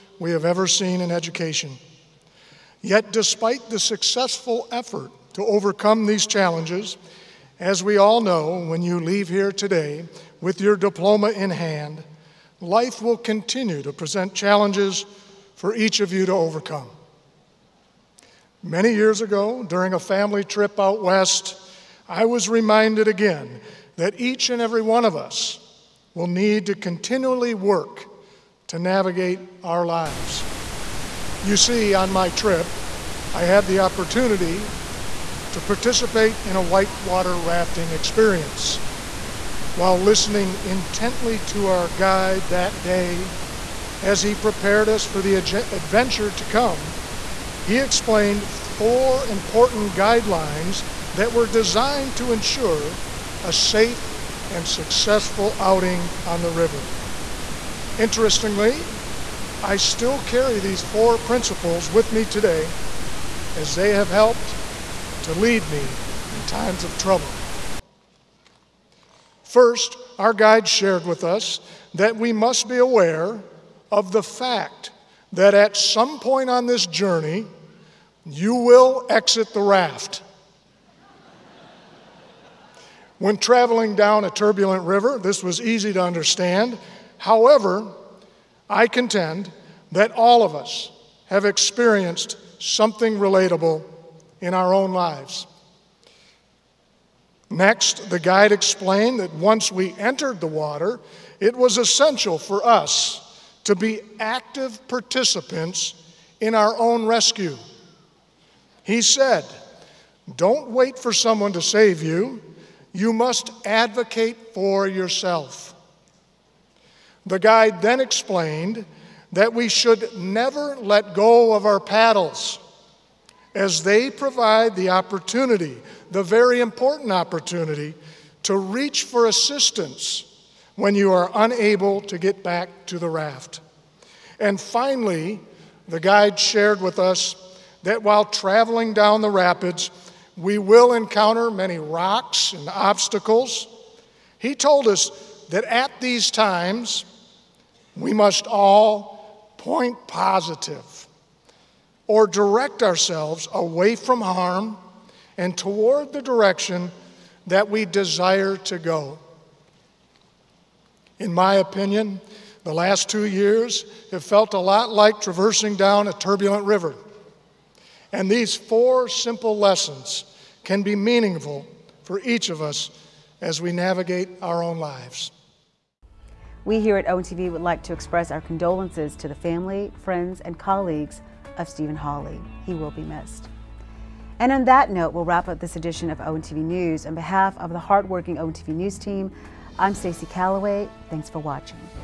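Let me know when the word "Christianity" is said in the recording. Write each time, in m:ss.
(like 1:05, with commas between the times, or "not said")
not said.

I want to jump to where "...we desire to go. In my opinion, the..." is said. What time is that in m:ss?
2:37.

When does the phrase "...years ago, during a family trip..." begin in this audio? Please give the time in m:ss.
0:18.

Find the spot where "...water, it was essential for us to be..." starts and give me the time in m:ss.
1:40.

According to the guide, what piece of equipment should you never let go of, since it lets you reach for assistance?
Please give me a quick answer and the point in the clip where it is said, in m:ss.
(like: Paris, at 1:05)
paddles, at 2:01.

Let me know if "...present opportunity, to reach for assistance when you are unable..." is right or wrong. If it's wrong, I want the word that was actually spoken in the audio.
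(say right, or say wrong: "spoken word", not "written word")
wrong: "important", not "present".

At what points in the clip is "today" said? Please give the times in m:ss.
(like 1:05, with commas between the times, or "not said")
0:09, 1:02.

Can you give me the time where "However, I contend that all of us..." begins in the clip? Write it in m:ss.
1:27.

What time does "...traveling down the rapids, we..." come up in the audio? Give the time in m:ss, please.
2:18.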